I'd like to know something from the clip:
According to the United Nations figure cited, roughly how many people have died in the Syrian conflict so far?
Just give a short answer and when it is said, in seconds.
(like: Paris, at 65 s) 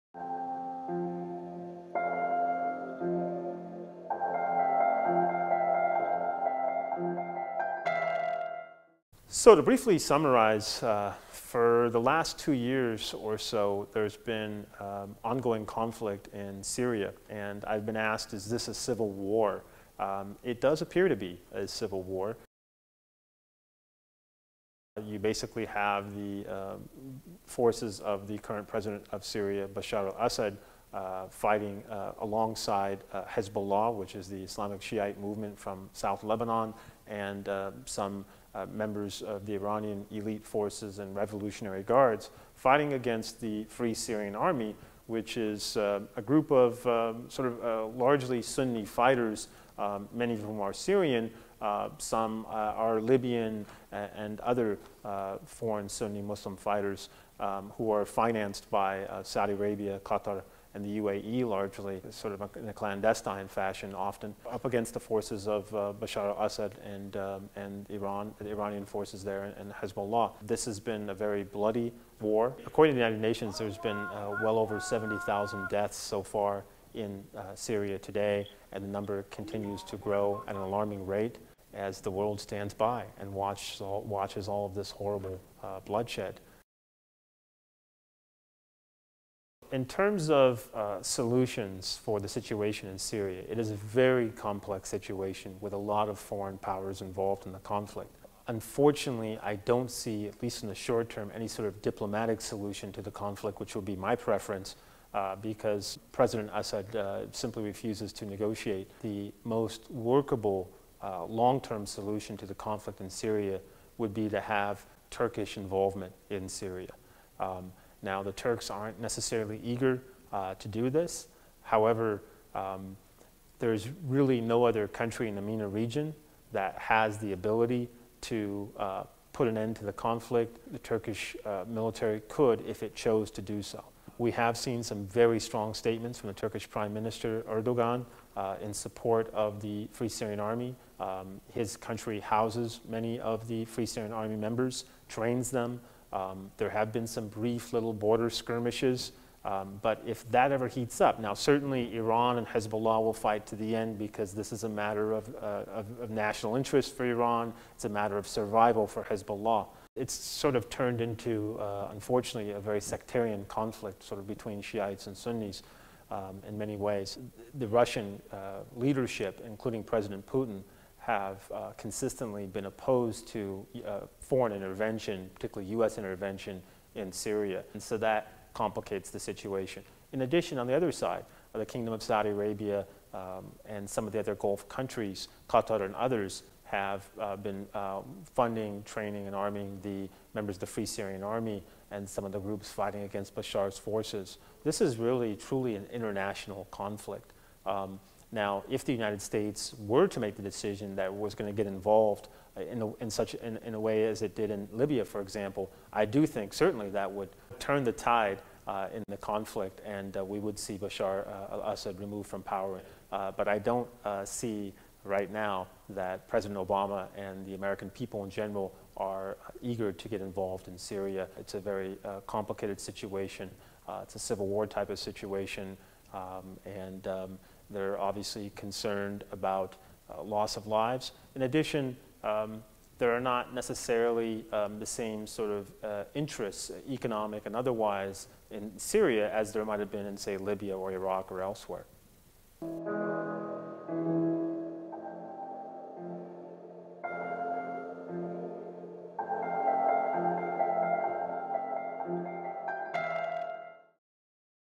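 70,000, at 74 s.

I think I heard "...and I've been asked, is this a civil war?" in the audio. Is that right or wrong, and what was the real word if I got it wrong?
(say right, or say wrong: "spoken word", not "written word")
right.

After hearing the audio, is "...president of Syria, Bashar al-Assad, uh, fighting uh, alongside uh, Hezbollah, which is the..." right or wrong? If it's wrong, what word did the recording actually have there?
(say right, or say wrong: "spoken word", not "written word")
right.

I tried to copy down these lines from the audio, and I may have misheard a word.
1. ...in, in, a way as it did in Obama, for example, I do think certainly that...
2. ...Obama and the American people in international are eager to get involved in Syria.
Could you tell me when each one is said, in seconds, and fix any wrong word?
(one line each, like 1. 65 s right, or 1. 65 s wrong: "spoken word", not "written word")
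1. 203 s wrong: "Libya", not "Obama"
2. 216 s wrong: "general", not "international".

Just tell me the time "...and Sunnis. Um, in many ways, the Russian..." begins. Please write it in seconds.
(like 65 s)
165 s.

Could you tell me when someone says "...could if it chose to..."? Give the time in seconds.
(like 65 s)
132 s.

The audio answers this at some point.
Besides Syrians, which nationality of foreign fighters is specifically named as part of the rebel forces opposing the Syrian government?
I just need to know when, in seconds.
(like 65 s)
52 s.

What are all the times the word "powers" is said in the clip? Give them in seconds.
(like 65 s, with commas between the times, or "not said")
96 s, 212 s.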